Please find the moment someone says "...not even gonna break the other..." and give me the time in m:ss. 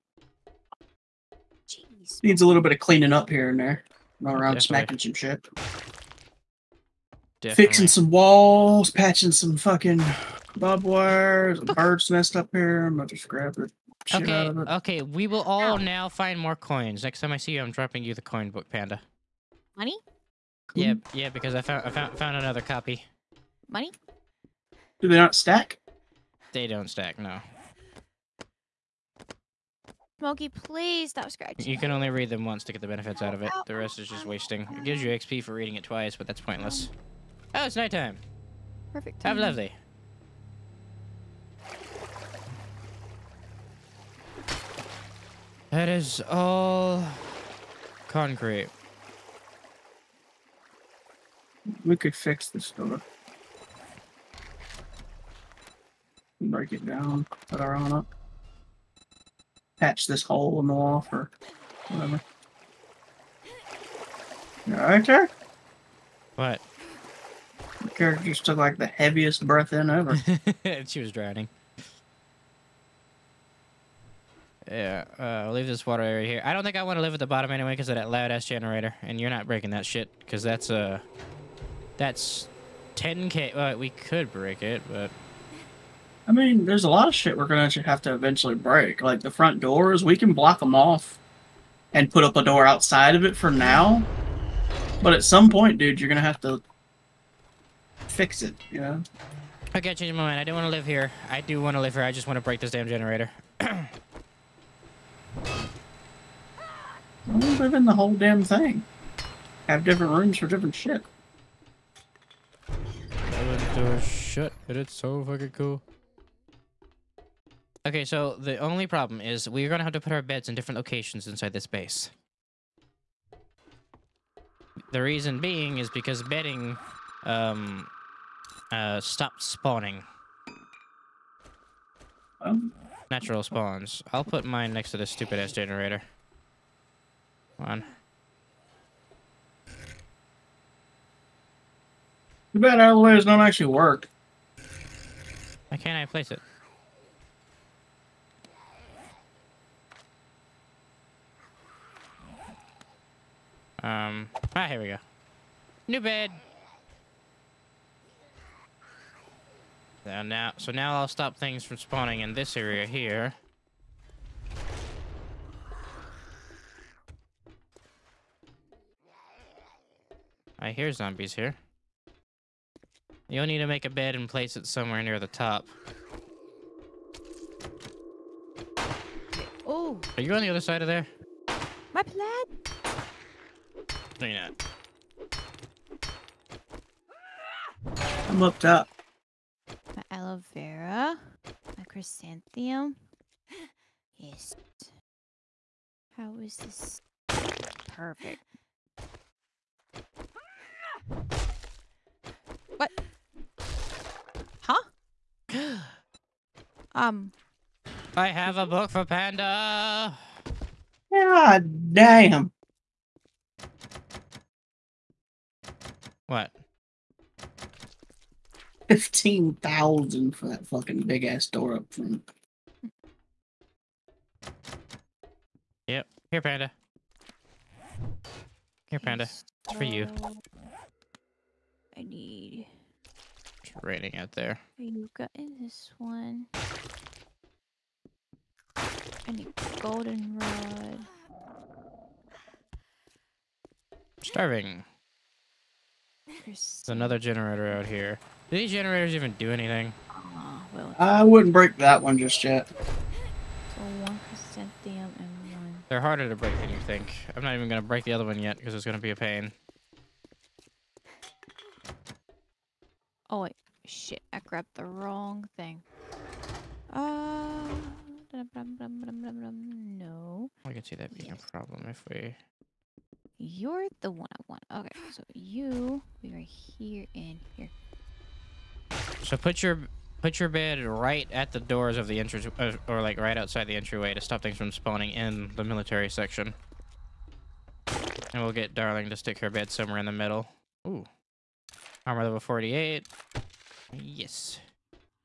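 4:17.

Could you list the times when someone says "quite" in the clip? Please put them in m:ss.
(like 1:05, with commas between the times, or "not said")
not said.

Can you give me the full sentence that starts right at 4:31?
a problem if we you're the one I want.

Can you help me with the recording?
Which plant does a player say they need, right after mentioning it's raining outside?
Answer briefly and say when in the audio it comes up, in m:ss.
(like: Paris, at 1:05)
Goldenrod, at 3:59.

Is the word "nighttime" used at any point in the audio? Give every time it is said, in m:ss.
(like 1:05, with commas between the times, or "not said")
0:37.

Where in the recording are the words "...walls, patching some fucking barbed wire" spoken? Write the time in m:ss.
0:08.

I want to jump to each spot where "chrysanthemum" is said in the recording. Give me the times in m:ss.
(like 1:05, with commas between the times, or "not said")
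3:11, 4:14.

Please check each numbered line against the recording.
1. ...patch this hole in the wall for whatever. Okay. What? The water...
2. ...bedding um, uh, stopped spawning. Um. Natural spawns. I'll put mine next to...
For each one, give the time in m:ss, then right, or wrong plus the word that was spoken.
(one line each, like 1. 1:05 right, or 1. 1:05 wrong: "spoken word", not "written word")
1. 0:59 wrong: "character", not "water"
2. 2:06 right.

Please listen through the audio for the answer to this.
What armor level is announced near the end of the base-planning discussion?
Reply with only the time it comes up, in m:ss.
4:52.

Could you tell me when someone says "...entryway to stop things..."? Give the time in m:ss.
4:43.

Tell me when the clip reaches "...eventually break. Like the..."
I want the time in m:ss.
1:28.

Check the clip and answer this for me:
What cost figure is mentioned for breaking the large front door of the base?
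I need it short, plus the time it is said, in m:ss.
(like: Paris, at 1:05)
15,000, at 3:38.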